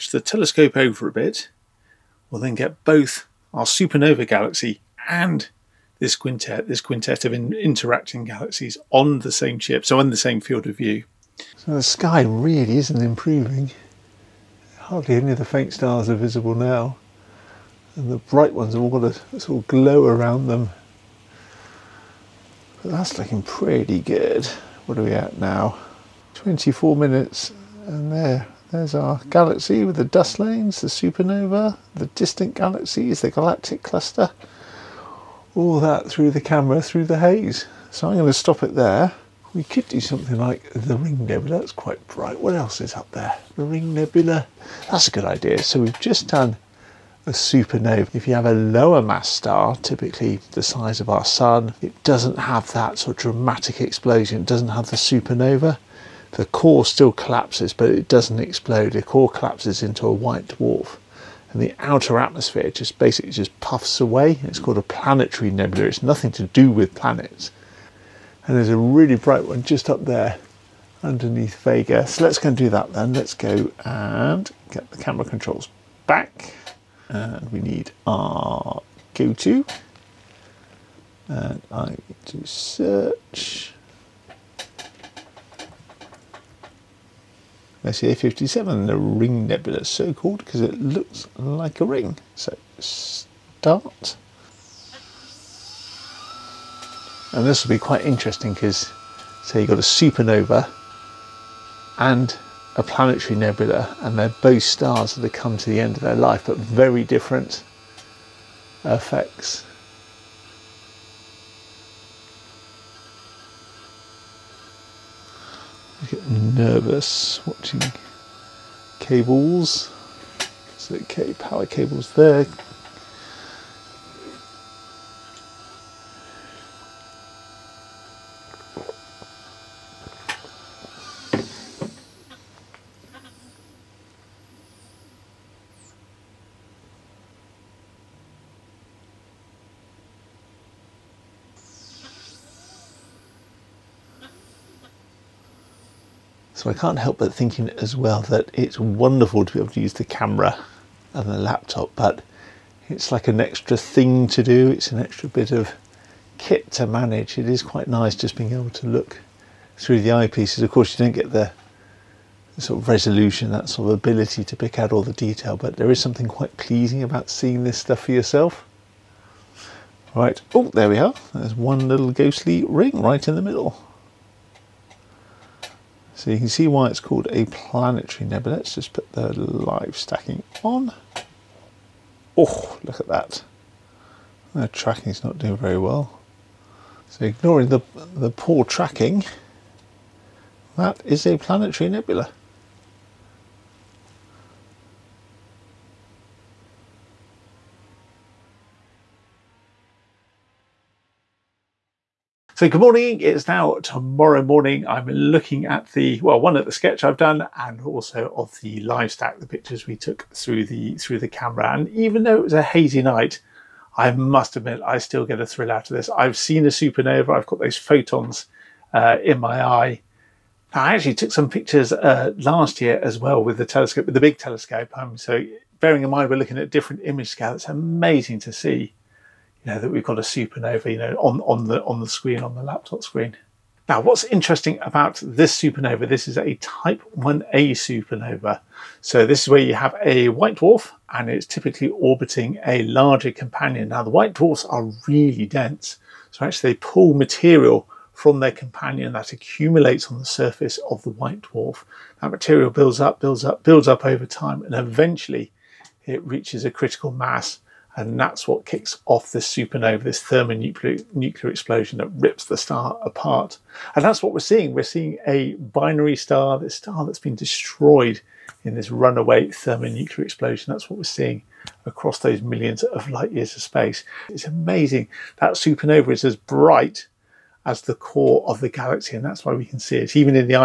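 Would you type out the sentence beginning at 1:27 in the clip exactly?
M57, the Ring Nebula, so called because it looks like a ring.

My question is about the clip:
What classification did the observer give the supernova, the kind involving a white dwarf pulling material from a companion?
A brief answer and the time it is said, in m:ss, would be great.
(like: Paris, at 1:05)
Type 1a, at 3:56.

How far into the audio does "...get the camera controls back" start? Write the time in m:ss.
1:14.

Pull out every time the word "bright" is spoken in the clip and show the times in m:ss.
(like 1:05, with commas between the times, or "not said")
0:18, 0:42, 1:09, 4:36.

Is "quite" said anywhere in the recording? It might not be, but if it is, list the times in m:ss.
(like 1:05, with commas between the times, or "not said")
0:41, 1:37, 2:37, 2:46.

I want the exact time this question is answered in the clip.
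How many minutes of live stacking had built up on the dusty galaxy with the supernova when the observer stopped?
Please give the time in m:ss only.
0:26.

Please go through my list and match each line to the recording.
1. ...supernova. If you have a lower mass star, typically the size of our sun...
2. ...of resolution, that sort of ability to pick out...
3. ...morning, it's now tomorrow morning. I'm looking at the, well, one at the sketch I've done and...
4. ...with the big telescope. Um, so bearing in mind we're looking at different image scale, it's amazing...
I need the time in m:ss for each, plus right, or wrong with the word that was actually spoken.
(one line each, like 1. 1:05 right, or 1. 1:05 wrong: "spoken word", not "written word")
1. 0:47 right
2. 2:42 right
3. 3:22 right
4. 3:44 right.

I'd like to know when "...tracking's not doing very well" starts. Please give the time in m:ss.
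3:04.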